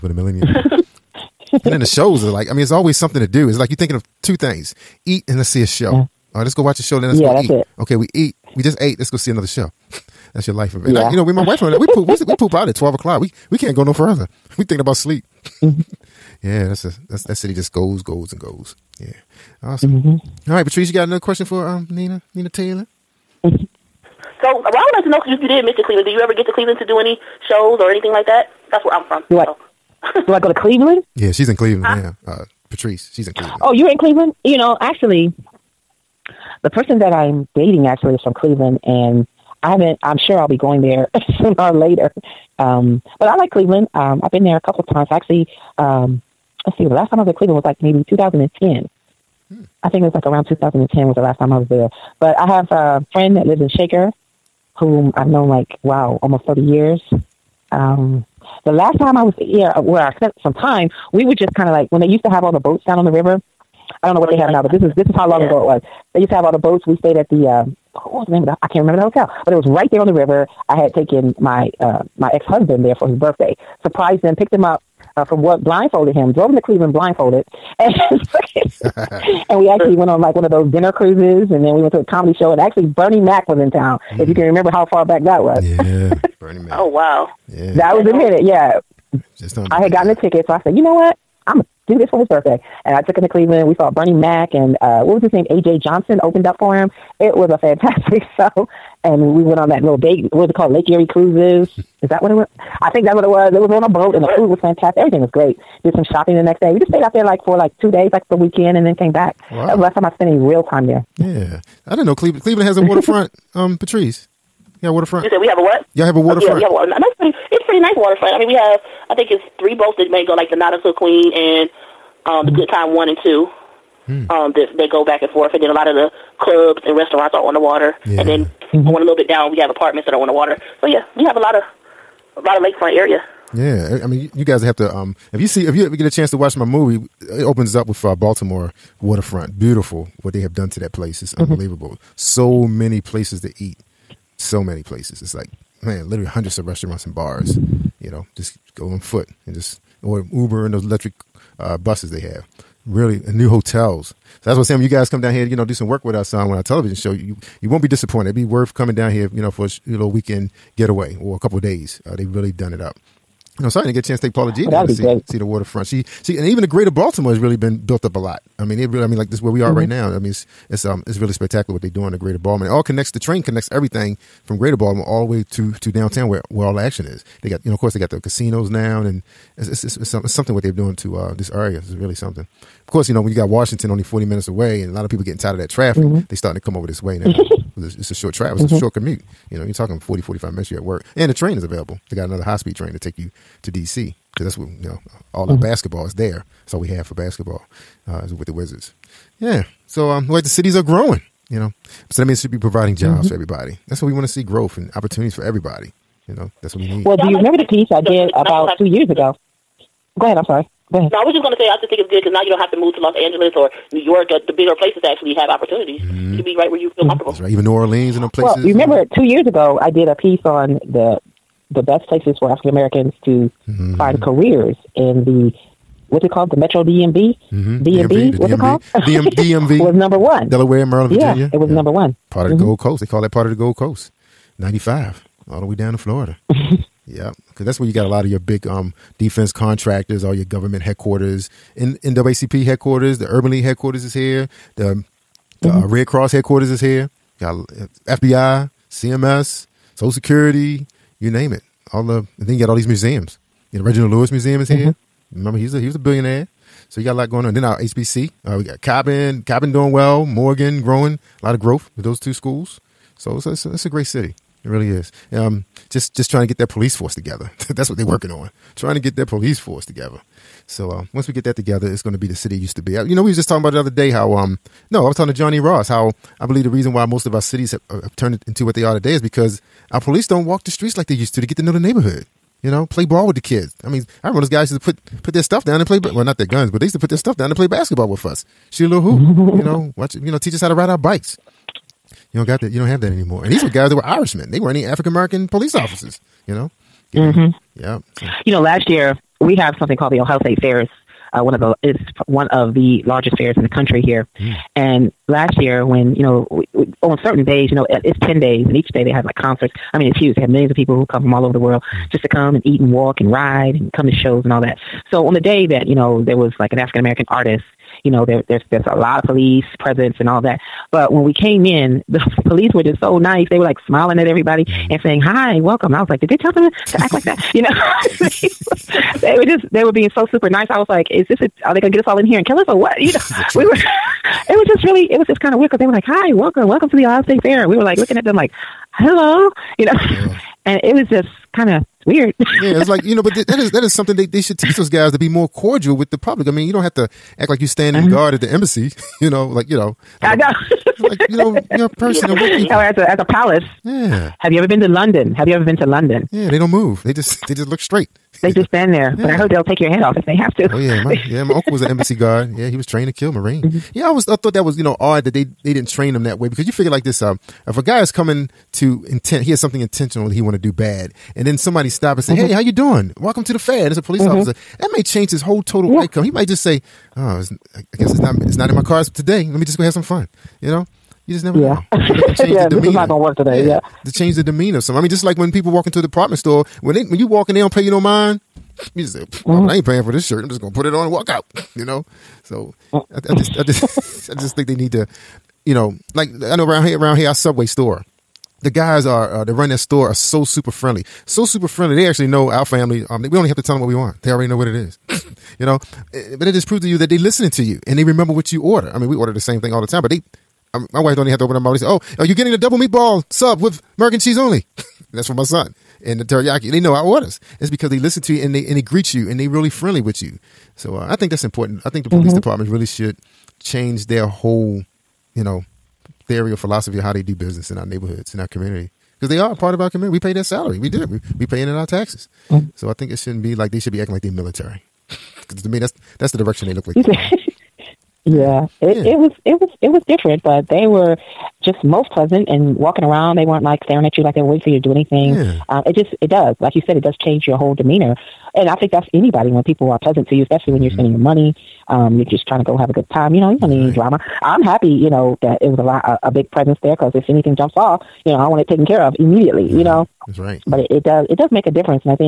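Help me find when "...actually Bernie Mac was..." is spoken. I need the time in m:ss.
1:22.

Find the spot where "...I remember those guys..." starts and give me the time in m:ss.
4:44.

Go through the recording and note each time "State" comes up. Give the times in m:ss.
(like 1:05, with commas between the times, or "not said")
5:00, 5:37.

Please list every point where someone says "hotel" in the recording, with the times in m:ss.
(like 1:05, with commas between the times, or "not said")
1:09, 2:33.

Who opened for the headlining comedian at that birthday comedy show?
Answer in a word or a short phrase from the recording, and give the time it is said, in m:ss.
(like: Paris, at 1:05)
AJ Johnson, at 1:35.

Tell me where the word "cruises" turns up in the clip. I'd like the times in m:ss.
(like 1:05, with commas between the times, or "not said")
1:20, 1:41.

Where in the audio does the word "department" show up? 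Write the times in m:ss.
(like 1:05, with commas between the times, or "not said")
6:26, 7:02.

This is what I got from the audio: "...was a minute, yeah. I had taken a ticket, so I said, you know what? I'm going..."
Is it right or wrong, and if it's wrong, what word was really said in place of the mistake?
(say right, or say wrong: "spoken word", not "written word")
wrong: "gotten", not "taken".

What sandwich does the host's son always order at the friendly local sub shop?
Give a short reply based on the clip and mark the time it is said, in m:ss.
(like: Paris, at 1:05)
Double meatball sub, at 6:52.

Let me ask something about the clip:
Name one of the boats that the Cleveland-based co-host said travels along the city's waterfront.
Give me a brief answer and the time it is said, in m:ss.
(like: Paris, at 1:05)
Nautica Queen, at 2:00.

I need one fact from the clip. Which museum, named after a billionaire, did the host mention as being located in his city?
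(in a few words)
Reginald Lewis Museum.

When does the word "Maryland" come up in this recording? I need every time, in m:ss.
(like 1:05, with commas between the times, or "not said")
3:50.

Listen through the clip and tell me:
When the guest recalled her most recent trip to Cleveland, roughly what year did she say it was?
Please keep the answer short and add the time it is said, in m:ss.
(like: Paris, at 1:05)
2010, at 0:47.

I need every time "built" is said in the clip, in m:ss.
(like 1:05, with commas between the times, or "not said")
2:47.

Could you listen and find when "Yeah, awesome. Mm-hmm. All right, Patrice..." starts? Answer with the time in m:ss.
0:19.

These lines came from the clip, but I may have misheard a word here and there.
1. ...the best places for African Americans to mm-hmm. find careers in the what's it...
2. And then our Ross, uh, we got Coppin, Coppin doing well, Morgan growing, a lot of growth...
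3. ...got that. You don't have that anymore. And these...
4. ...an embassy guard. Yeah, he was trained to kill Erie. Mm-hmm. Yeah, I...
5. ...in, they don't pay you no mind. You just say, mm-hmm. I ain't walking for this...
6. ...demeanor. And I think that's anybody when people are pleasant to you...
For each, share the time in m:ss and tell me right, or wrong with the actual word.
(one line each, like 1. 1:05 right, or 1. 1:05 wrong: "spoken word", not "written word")
1. 3:41 right
2. 4:17 wrong: "HBC", not "Ross"
3. 4:52 right
4. 6:01 wrong: "Marine", not "Erie"
5. 6:27 wrong: "paying", not "walking"
6. 7:27 right.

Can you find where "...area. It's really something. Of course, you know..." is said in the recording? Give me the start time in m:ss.
3:01.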